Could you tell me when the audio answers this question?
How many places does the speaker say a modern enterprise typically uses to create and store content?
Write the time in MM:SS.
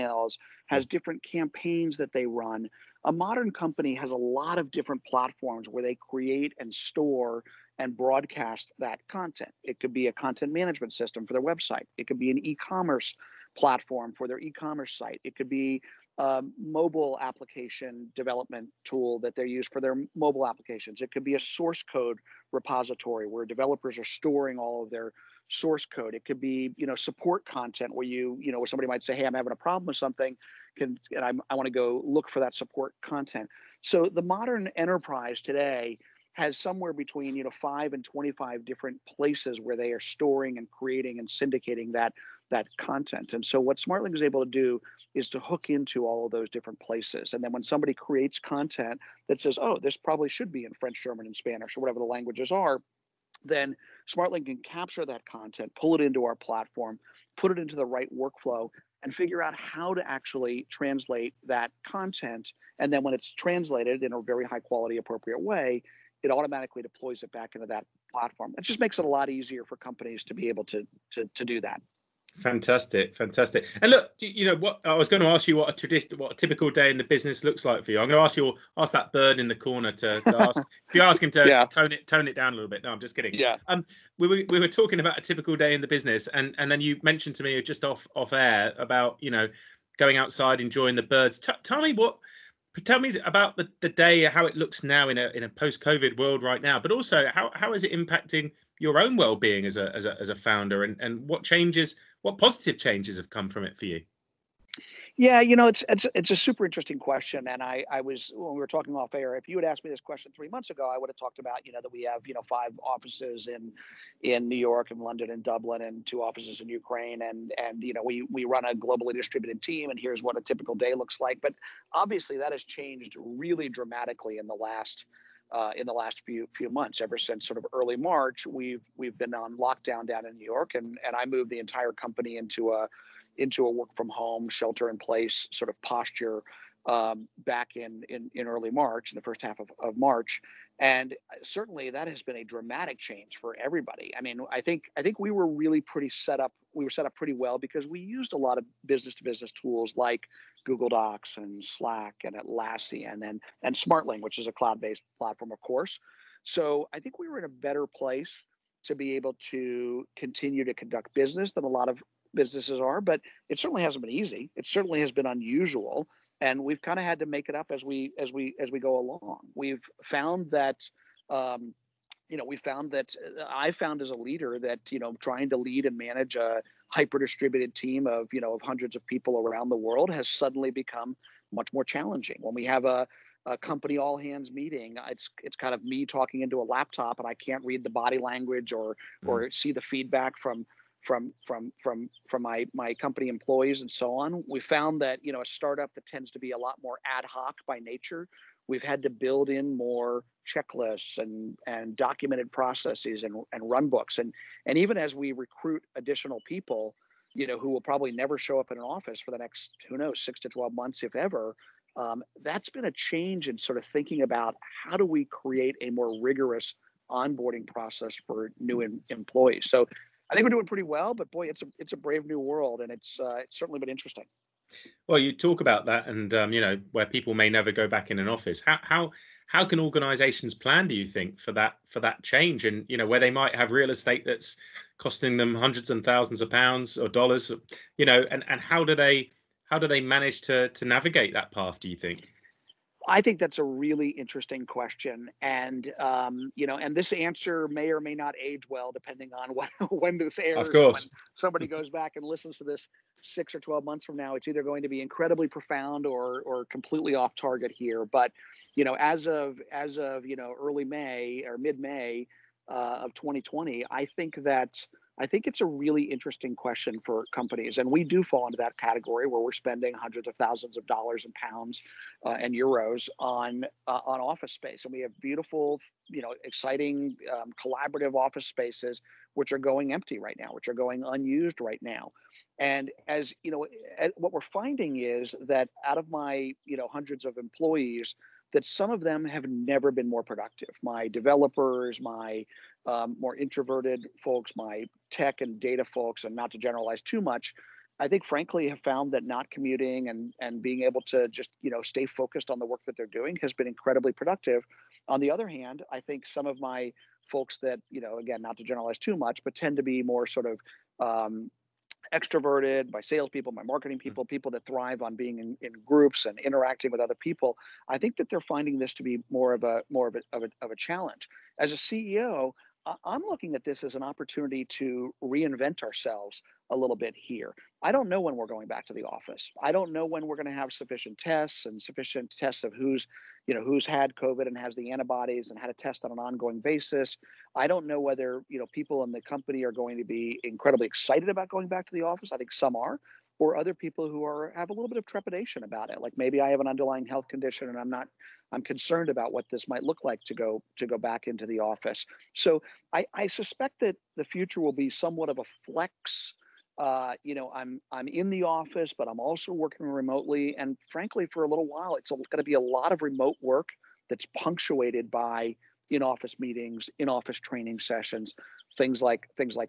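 00:37.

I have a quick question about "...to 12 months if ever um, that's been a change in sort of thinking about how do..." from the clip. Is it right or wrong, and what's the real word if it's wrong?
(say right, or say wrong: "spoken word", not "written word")
right.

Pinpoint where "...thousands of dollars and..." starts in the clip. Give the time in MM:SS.
04:30.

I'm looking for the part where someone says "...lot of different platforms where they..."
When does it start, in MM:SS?
00:04.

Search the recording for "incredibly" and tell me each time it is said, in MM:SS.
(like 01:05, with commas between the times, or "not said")
04:15, 05:03, 05:40.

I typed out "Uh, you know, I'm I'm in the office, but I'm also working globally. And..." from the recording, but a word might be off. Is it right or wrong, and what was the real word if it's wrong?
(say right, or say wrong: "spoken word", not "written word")
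wrong: "remotely", not "globally".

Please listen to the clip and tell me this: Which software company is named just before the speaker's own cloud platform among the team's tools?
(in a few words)
Atlassian.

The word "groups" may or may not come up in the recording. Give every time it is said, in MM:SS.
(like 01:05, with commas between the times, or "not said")
05:15.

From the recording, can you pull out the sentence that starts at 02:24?
I mean, I think I think we were really pretty set up.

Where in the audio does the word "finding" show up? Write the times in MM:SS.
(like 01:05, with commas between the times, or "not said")
04:44, 05:18.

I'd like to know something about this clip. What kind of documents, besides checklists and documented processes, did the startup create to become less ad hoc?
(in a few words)
Run books.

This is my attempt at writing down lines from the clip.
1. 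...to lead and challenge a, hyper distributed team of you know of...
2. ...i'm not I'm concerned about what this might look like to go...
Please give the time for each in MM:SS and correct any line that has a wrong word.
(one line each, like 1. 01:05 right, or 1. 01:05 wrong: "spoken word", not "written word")
1. 02:55 wrong: "manage", not "challenge"
2. 05:47 right.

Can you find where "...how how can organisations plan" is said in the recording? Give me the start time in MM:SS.
03:48.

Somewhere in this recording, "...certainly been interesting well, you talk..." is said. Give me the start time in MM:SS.
03:43.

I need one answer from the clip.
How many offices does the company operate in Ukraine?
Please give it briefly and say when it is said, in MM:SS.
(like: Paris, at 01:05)
2, at 01:56.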